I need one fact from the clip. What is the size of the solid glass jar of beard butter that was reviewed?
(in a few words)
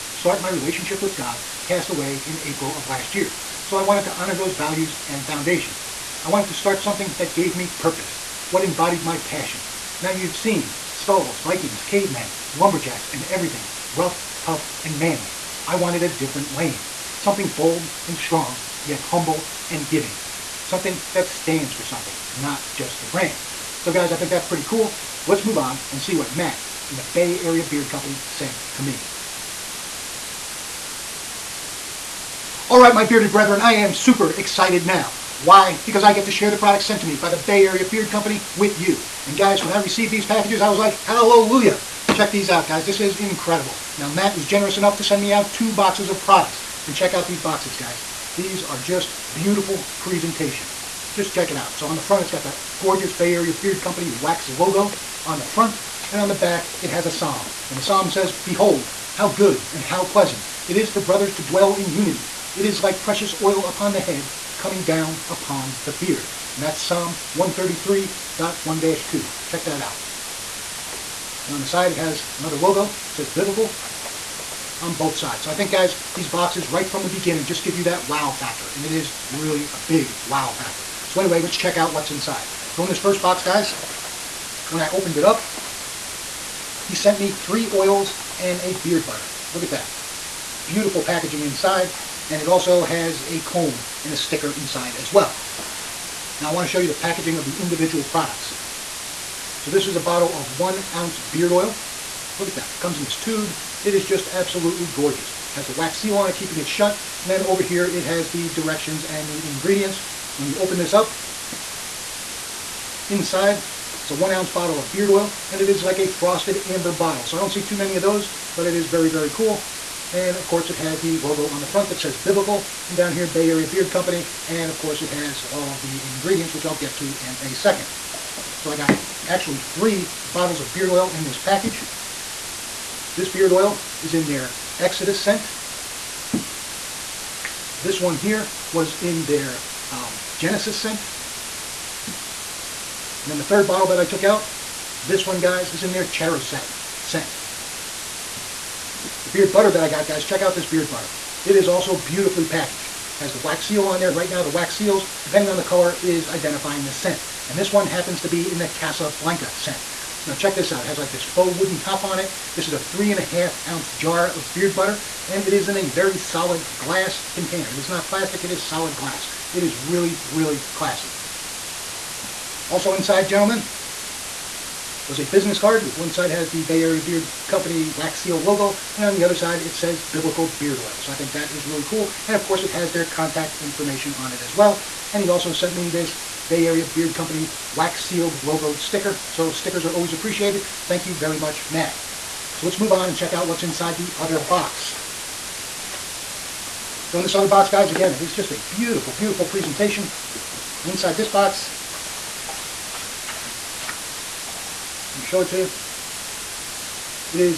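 3.5 ounces.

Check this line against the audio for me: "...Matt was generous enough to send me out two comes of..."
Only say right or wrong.
wrong.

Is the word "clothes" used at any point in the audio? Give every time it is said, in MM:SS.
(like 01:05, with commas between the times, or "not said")
not said.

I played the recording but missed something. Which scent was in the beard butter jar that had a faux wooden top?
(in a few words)
Casablanca.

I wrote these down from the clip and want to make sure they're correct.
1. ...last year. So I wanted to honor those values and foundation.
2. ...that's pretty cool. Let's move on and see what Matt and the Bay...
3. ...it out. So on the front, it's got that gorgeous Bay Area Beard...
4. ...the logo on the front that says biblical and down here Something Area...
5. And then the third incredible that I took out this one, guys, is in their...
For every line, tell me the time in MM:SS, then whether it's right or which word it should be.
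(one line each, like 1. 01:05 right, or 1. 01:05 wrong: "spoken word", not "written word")
1. 00:02 right
2. 00:24 right
3. 00:51 right
4. 02:01 wrong: "Bay", not "Something"
5. 02:22 wrong: "bottle", not "incredible".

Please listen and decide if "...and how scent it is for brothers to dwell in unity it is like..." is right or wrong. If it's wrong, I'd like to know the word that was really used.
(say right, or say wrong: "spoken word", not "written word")
wrong: "pleasant", not "scent".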